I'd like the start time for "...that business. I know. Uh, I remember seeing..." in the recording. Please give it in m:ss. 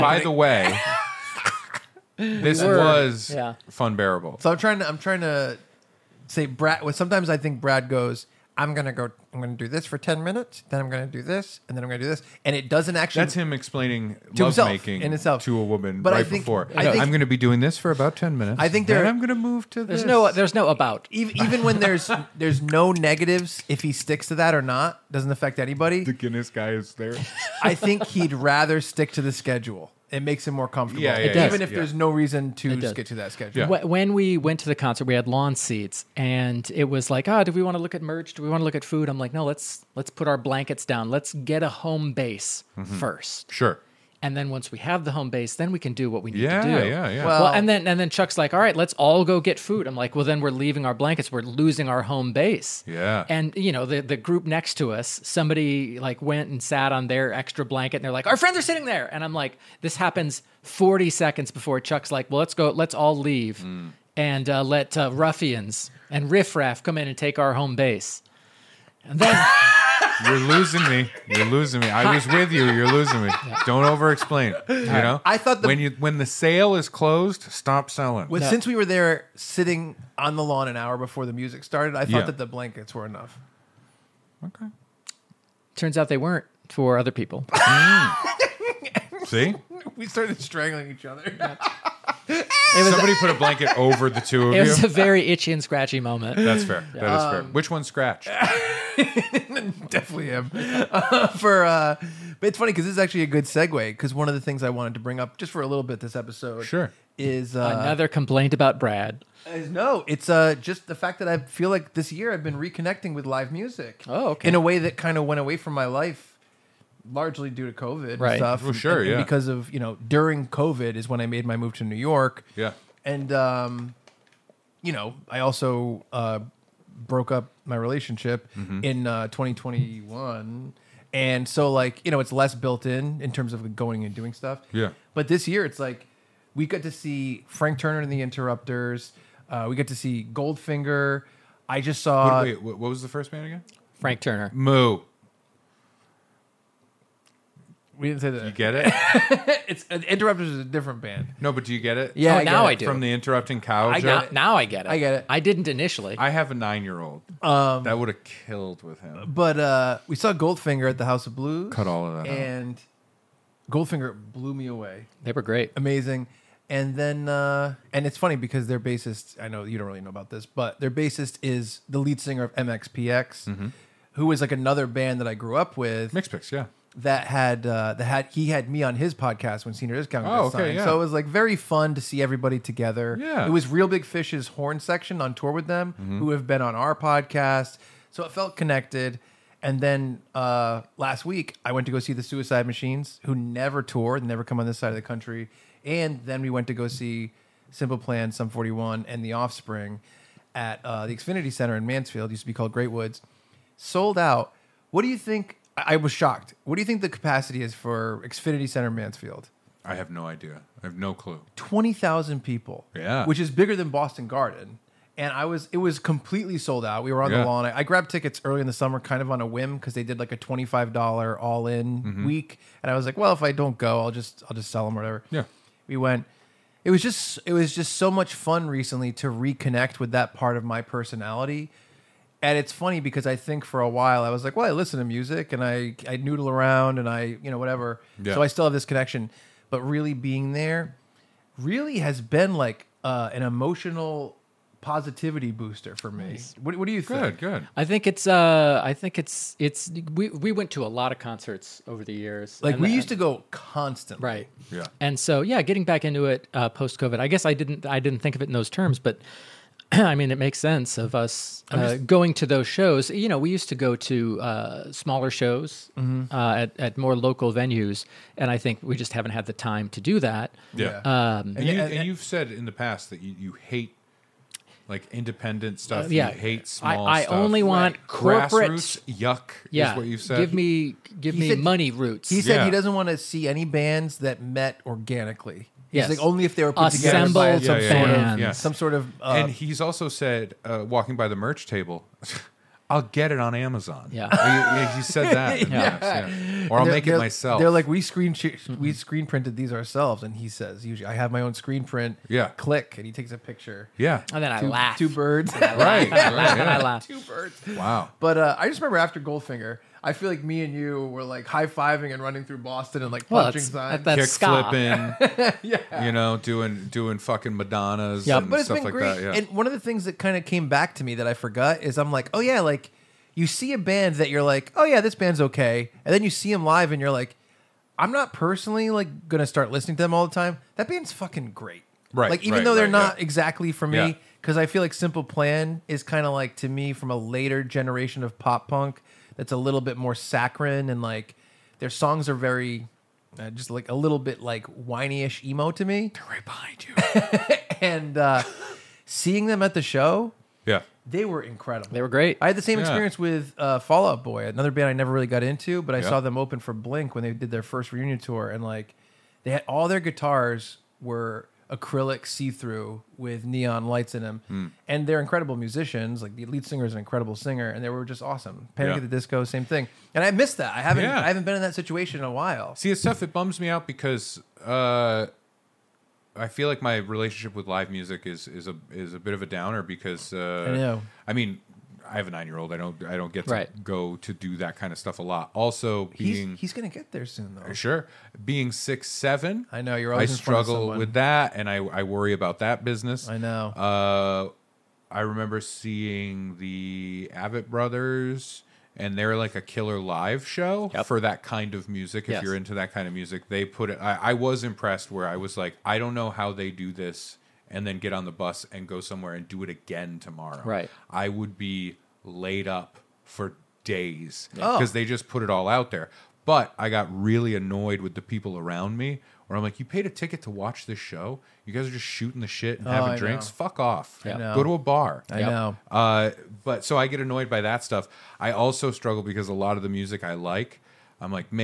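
6:32.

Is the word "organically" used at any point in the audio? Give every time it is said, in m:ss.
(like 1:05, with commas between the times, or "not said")
4:44.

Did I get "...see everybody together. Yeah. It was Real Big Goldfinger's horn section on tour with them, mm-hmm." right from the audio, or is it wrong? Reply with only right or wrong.
wrong.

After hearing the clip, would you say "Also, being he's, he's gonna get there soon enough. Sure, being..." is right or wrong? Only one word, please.
wrong.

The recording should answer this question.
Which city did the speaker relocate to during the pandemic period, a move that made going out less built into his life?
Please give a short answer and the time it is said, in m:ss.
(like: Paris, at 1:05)
New York, at 2:01.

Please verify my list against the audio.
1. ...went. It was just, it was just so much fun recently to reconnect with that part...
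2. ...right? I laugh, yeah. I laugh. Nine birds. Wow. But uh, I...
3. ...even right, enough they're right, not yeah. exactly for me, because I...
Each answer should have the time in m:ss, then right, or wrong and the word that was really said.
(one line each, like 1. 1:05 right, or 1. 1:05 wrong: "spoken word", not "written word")
1. 3:45 right
2. 5:05 wrong: "Two", not "Nine"
3. 5:32 wrong: "though", not "enough".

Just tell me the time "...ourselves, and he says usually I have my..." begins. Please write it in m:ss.
4:59.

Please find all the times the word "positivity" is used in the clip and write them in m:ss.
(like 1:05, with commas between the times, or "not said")
4:04.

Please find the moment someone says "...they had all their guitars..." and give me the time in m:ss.
5:59.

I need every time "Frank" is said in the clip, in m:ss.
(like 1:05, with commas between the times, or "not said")
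2:17, 2:23.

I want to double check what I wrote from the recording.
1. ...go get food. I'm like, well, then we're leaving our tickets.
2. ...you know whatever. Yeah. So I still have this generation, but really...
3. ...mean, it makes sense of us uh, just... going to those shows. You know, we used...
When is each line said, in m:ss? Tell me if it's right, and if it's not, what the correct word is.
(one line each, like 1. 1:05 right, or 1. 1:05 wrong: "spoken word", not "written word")
1. 0:49 wrong: "blankets", not "tickets"
2. 3:57 wrong: "connection", not "generation"
3. 4:20 right.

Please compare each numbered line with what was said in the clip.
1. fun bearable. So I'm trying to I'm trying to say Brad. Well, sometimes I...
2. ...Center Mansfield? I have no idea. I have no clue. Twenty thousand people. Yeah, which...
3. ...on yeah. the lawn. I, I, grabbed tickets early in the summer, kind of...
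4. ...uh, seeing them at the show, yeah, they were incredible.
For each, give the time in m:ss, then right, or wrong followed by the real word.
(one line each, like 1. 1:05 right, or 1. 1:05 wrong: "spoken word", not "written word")
1. 0:03 right
2. 3:28 right
3. 3:37 right
4. 5:48 right.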